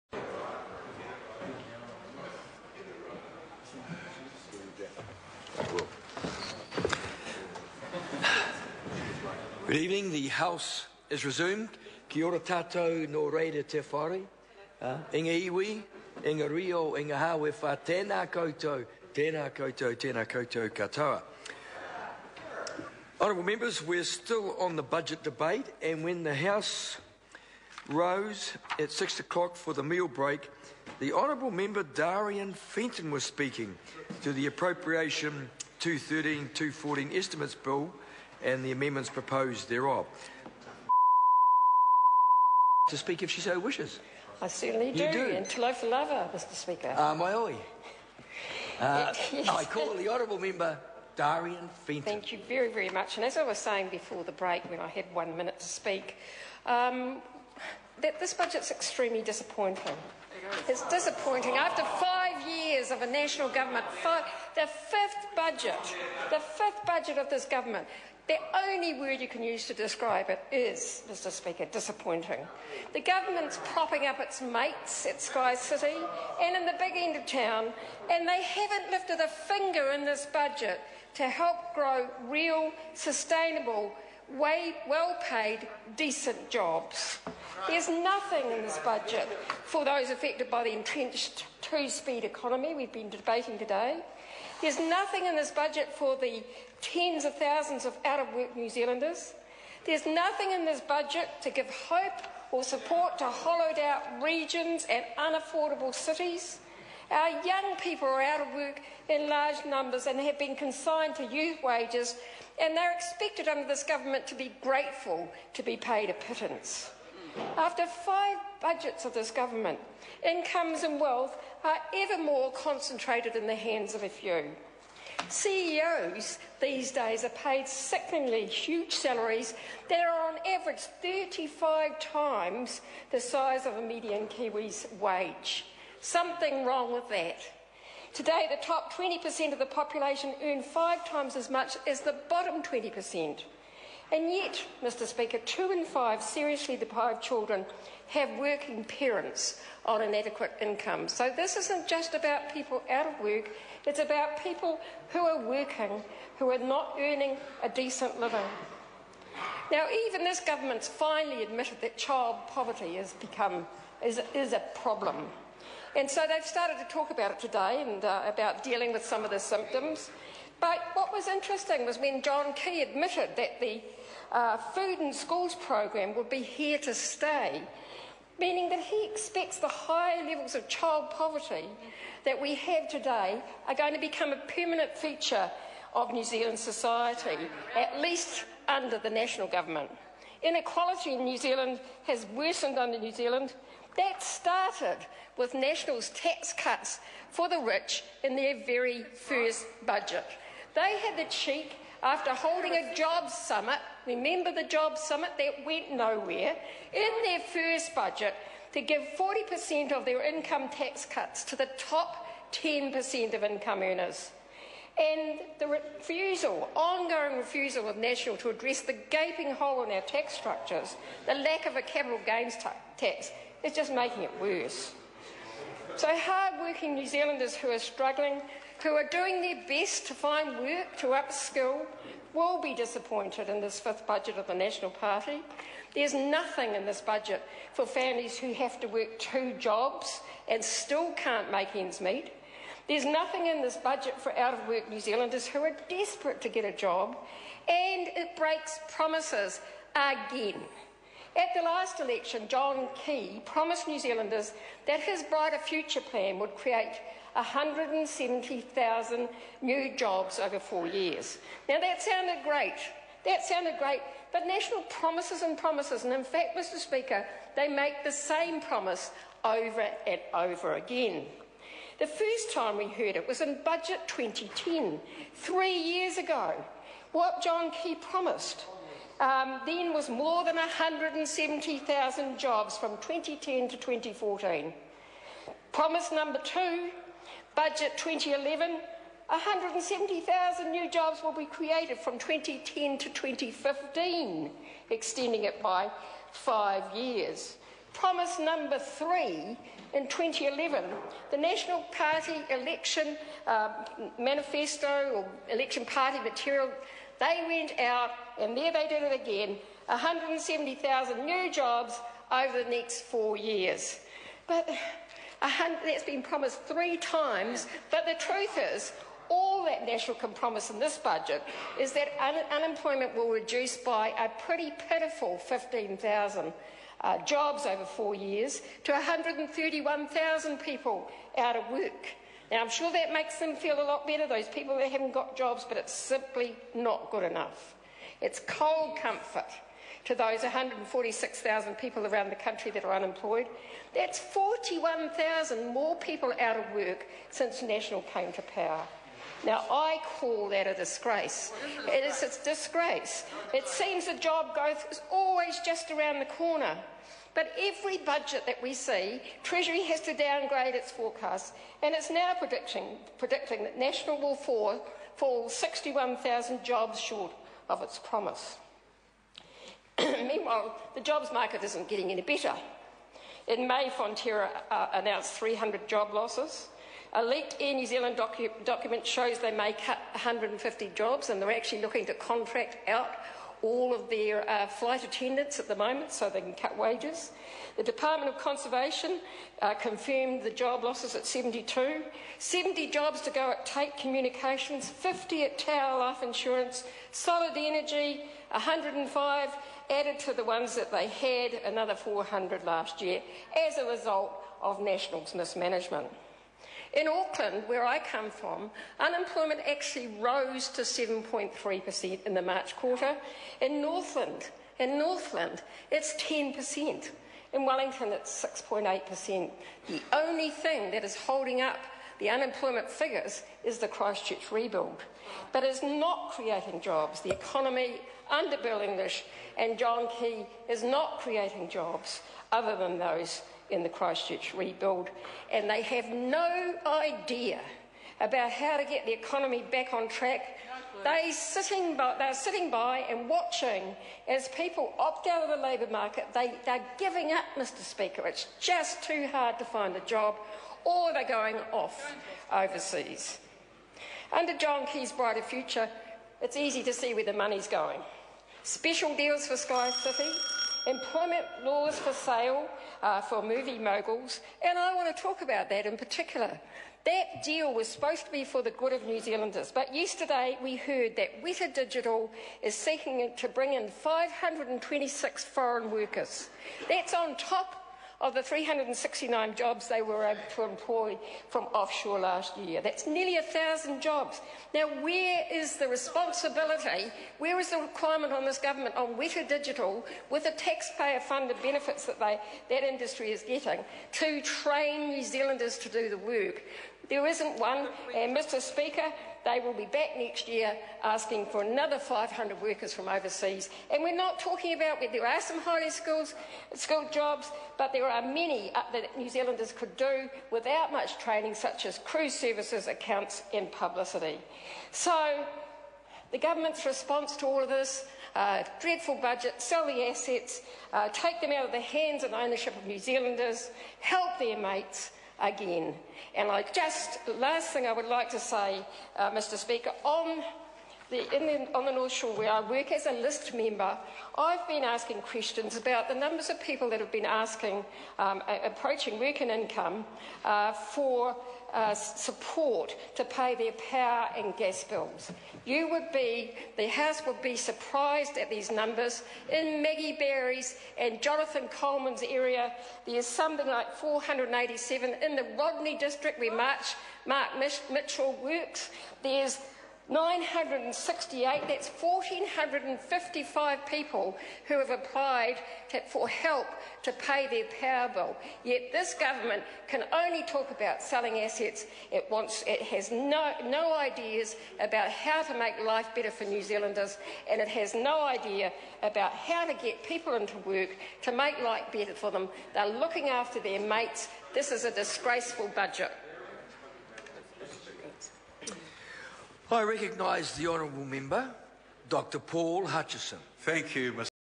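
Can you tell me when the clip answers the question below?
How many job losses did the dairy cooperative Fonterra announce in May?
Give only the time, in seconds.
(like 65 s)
375 s.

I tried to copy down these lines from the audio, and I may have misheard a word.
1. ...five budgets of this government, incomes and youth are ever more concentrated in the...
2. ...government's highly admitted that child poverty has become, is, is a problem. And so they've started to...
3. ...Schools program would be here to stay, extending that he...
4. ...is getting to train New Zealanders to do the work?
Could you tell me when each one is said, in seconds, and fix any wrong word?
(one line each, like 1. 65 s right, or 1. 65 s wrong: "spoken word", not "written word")
1. 117 s wrong: "wealth", not "youth"
2. 160 s wrong: "finally", not "highly"
3. 175 s wrong: "meaning", not "extending"
4. 493 s right.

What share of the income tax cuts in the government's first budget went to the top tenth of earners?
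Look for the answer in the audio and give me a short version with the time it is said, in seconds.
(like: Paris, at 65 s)
40%, at 209 s.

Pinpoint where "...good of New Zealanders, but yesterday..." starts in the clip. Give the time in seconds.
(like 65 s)
468 s.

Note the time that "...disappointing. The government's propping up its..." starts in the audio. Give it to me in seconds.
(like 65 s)
71 s.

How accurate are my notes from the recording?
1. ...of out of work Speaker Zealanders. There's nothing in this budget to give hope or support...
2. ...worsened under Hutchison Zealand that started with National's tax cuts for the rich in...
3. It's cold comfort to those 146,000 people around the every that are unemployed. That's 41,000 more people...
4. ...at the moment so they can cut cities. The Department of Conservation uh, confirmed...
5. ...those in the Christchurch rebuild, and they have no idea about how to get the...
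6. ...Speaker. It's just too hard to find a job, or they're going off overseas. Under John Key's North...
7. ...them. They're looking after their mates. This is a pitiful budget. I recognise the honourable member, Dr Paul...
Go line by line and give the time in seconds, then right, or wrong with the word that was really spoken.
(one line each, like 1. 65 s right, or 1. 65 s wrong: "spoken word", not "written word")
1. 97 s wrong: "New", not "Speaker"
2. 192 s wrong: "New", not "Hutchison"
3. 338 s wrong: "country", not "every"
4. 385 s wrong: "wages", not "cities"
5. 432 s right
6. 447 s wrong: "Brighter", not "North"
7. 582 s wrong: "disgraceful", not "pitiful".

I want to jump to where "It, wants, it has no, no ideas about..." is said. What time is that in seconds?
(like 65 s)
572 s.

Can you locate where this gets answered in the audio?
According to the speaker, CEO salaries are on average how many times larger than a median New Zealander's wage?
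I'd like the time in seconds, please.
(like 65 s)
130 s.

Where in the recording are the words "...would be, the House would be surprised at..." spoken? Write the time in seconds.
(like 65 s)
545 s.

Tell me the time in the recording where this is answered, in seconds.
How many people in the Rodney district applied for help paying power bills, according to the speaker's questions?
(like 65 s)
560 s.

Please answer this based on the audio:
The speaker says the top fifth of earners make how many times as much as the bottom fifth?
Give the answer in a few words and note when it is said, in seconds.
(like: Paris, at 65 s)
5, at 140 s.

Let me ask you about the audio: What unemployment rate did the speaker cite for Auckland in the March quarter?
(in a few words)
7.3%.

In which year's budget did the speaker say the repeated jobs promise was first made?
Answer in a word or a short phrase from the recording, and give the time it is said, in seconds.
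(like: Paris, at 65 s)
2010, at 273 s.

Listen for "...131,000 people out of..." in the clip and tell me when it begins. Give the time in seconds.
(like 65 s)
328 s.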